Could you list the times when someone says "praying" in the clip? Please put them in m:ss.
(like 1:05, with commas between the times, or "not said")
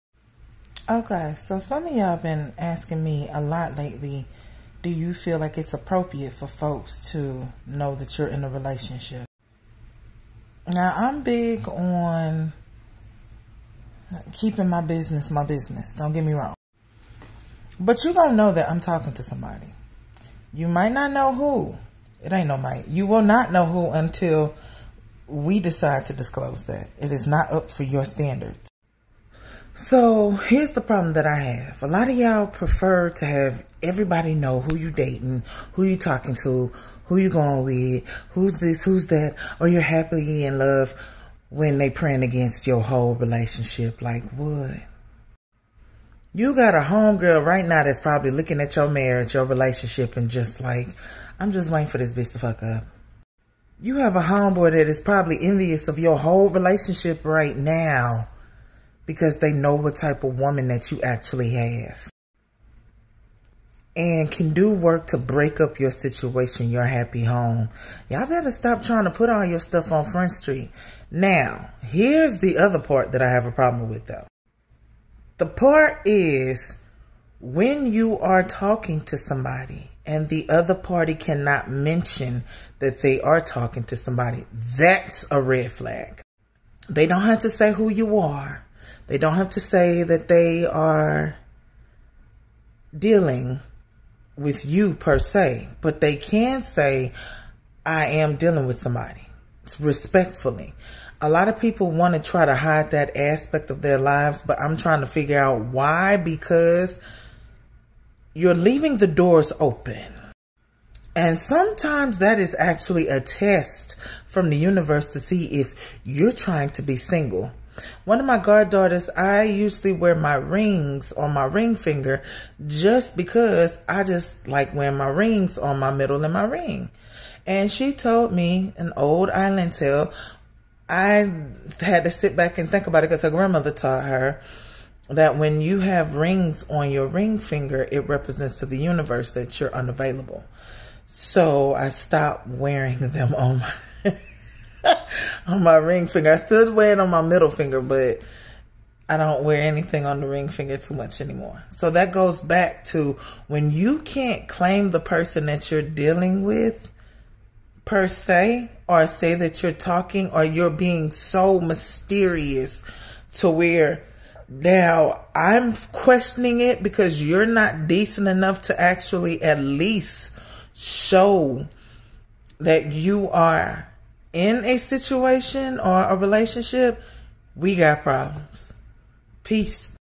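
0:41.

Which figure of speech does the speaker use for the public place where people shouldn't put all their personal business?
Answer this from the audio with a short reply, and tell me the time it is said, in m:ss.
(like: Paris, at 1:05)
Front Street, at 1:10.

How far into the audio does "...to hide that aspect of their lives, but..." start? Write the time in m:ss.
1:42.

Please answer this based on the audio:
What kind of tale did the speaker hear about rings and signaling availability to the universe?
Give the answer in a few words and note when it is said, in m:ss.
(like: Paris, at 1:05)
An old island tale, at 2:08.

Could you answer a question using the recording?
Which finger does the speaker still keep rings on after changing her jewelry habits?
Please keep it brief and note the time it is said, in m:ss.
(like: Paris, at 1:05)
Middle finger, at 2:27.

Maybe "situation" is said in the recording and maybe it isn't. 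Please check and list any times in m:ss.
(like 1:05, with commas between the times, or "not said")
1:05, 2:54.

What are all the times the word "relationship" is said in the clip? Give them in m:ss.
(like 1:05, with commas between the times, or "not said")
0:08, 0:43, 0:49, 0:56, 2:56.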